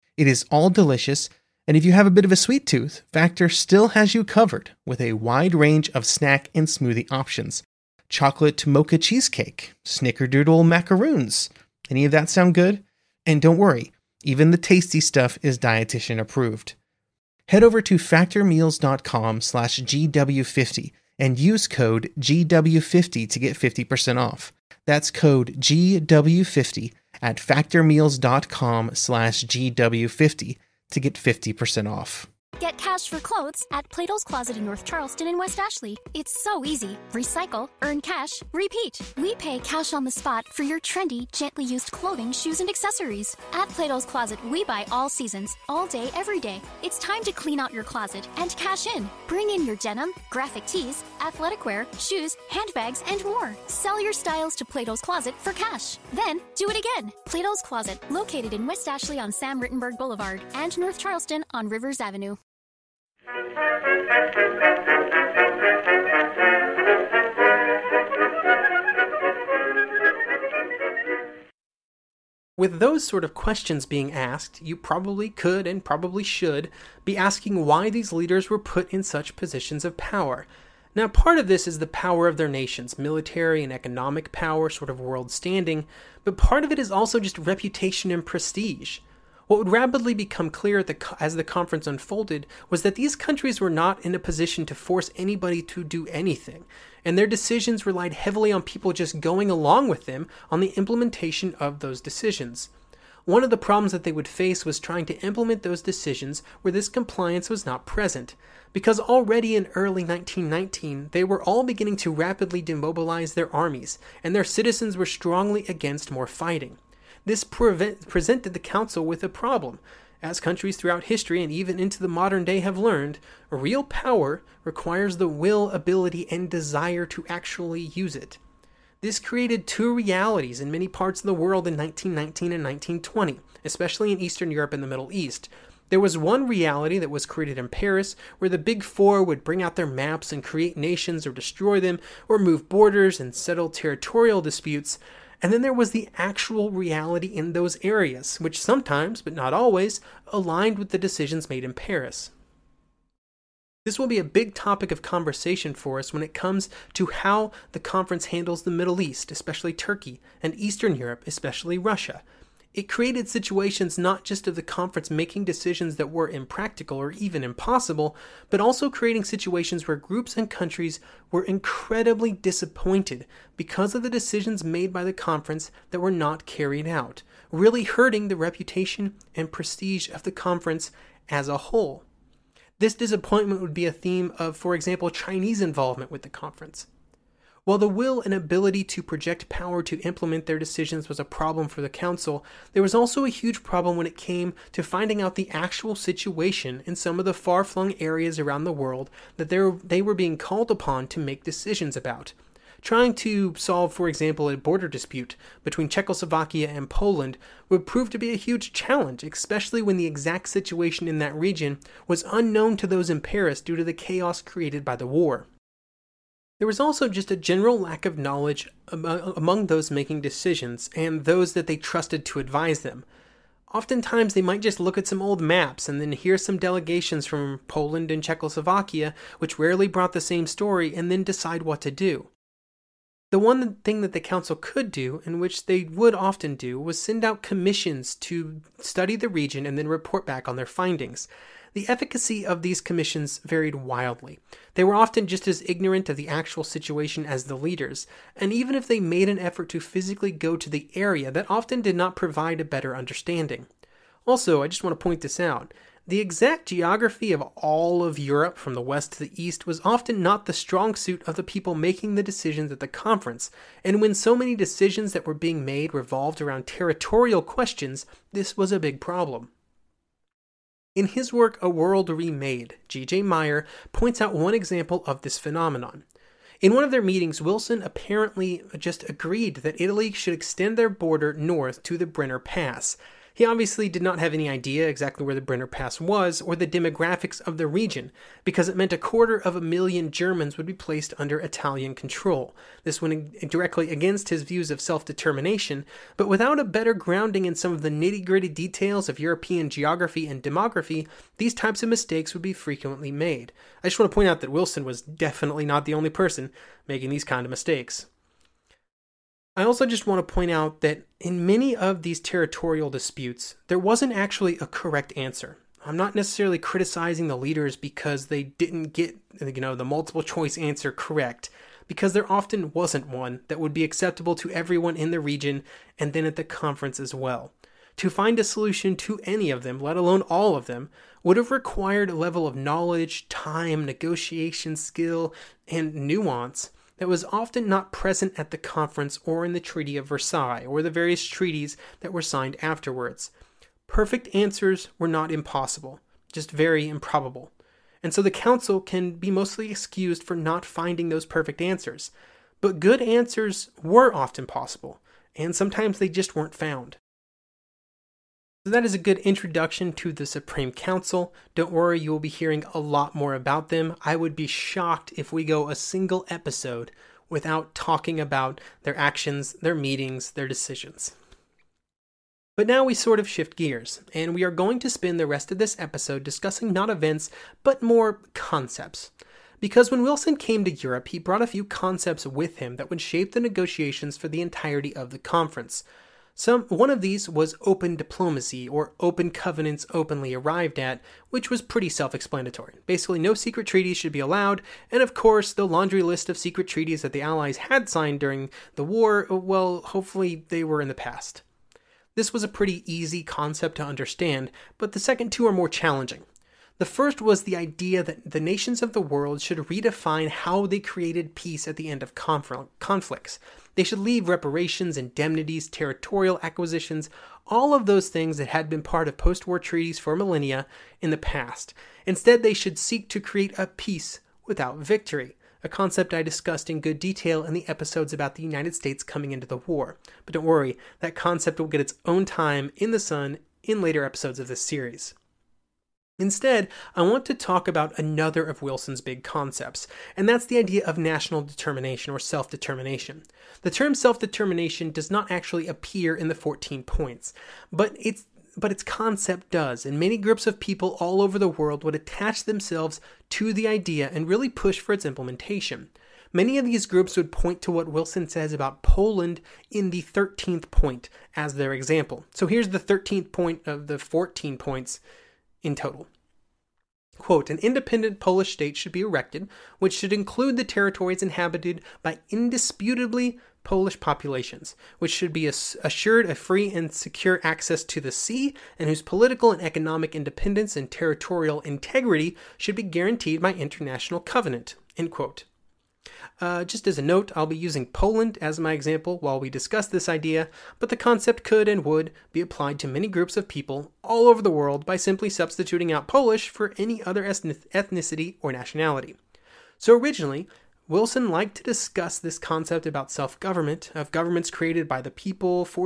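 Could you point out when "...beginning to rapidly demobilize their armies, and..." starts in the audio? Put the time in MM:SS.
01:51.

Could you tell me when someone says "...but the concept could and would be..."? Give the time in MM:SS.
08:10.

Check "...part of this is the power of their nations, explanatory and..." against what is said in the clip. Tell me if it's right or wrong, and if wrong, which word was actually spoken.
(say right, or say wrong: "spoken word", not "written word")
wrong: "military", not "explanatory".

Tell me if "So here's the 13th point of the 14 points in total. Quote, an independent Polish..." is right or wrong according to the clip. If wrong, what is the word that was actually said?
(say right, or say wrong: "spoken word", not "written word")
right.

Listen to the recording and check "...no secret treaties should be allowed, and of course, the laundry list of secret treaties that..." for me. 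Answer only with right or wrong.
right.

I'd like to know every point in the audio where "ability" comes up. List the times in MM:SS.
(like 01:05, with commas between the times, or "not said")
02:05, 03:08.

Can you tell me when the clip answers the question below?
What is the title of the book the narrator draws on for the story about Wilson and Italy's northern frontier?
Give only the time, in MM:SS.
04:31.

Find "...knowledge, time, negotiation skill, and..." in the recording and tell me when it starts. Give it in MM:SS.
05:32.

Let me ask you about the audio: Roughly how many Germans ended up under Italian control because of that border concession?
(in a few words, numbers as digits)
a quarter of a million.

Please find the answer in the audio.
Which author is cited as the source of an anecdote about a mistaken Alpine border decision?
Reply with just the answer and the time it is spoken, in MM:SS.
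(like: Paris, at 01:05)
G.J. Meyer, at 04:32.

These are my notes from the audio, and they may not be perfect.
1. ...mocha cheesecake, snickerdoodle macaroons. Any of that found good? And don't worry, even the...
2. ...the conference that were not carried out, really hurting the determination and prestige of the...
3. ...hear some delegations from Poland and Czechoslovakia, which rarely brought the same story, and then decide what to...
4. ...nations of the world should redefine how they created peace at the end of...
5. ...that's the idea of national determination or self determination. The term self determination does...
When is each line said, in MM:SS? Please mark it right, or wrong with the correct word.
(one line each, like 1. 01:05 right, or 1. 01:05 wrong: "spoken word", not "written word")
1. 00:08 wrong: "sound", not "found"
2. 02:55 wrong: "reputation", not "determination"
3. 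03:46 right
4. 06:48 right
5. 07:20 right.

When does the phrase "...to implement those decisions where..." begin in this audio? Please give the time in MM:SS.
01:45.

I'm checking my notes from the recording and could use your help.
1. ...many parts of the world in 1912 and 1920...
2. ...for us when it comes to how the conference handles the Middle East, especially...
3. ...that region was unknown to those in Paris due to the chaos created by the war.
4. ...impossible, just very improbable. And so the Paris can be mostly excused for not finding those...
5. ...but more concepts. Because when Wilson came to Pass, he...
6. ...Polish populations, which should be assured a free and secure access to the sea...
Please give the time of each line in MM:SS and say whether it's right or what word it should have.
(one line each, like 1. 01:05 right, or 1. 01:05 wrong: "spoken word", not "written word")
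1. 02:10 wrong: "1919", not "1912"
2. 02:35 right
3. 03:31 right
4. 05:45 wrong: "Council", not "Paris"
5. 06:17 wrong: "Europe", not "Pass"
6. 07:53 right.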